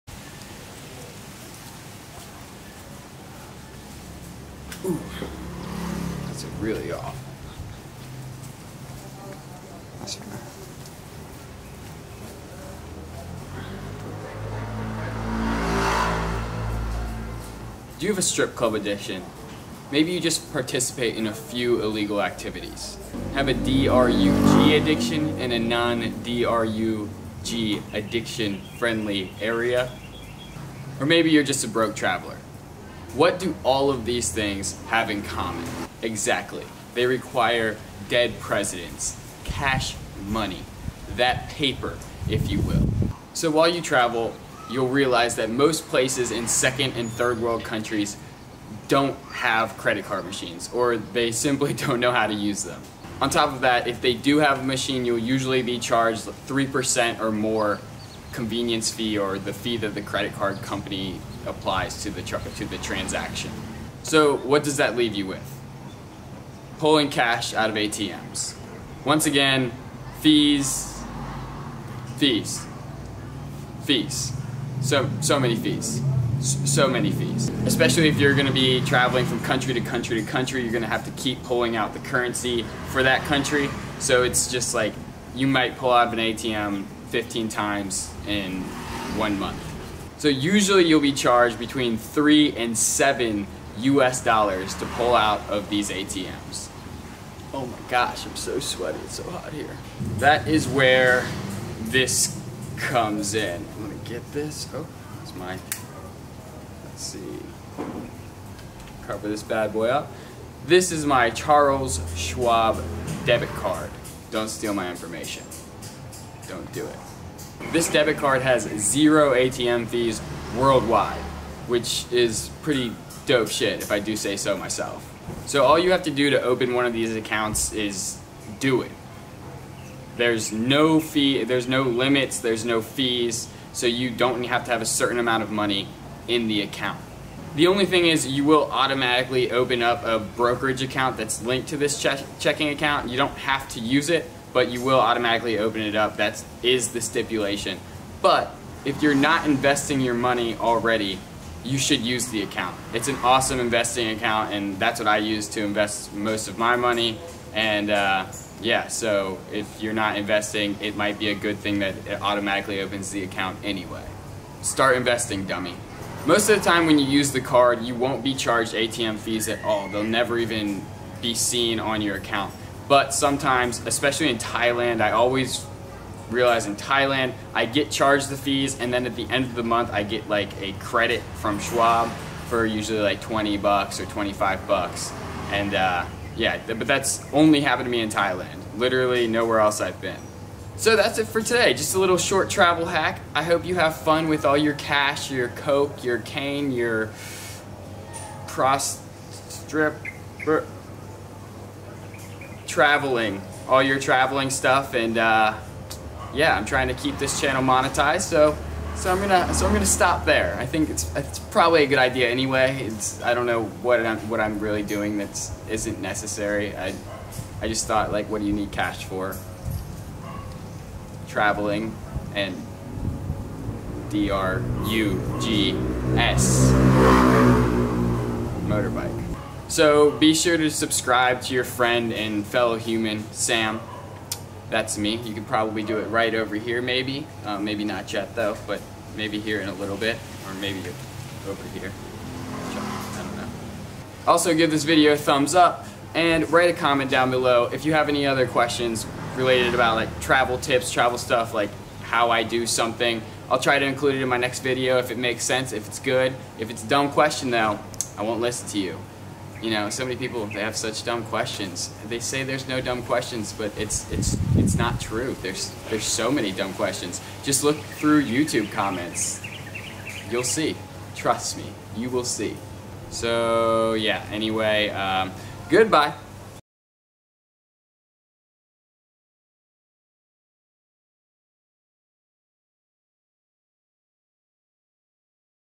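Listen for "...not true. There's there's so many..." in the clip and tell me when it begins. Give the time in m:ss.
4:24.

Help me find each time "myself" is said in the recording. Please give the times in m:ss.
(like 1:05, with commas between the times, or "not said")
2:04.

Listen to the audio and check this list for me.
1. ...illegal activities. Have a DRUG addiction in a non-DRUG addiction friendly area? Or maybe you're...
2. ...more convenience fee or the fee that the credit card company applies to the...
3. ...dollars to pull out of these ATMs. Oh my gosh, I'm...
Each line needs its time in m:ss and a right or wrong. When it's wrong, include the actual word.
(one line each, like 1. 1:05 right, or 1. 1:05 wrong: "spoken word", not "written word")
1. 0:21 right
2. 0:57 right
3. 1:34 right.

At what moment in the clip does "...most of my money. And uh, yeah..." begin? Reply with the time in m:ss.
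2:36.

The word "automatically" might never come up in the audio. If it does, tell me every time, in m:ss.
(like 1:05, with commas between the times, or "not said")
2:18, 2:24, 2:42.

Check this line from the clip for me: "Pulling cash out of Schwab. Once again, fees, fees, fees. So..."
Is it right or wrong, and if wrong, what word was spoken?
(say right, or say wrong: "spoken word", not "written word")
wrong: "ATMs", not "Schwab".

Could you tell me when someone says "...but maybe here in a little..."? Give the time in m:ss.
3:58.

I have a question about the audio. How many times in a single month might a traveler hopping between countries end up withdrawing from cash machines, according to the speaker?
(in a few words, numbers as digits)
15.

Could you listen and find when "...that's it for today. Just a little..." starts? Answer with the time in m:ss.
3:10.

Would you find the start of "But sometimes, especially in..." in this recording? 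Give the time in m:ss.
2:52.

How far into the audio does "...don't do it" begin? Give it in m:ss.
1:56.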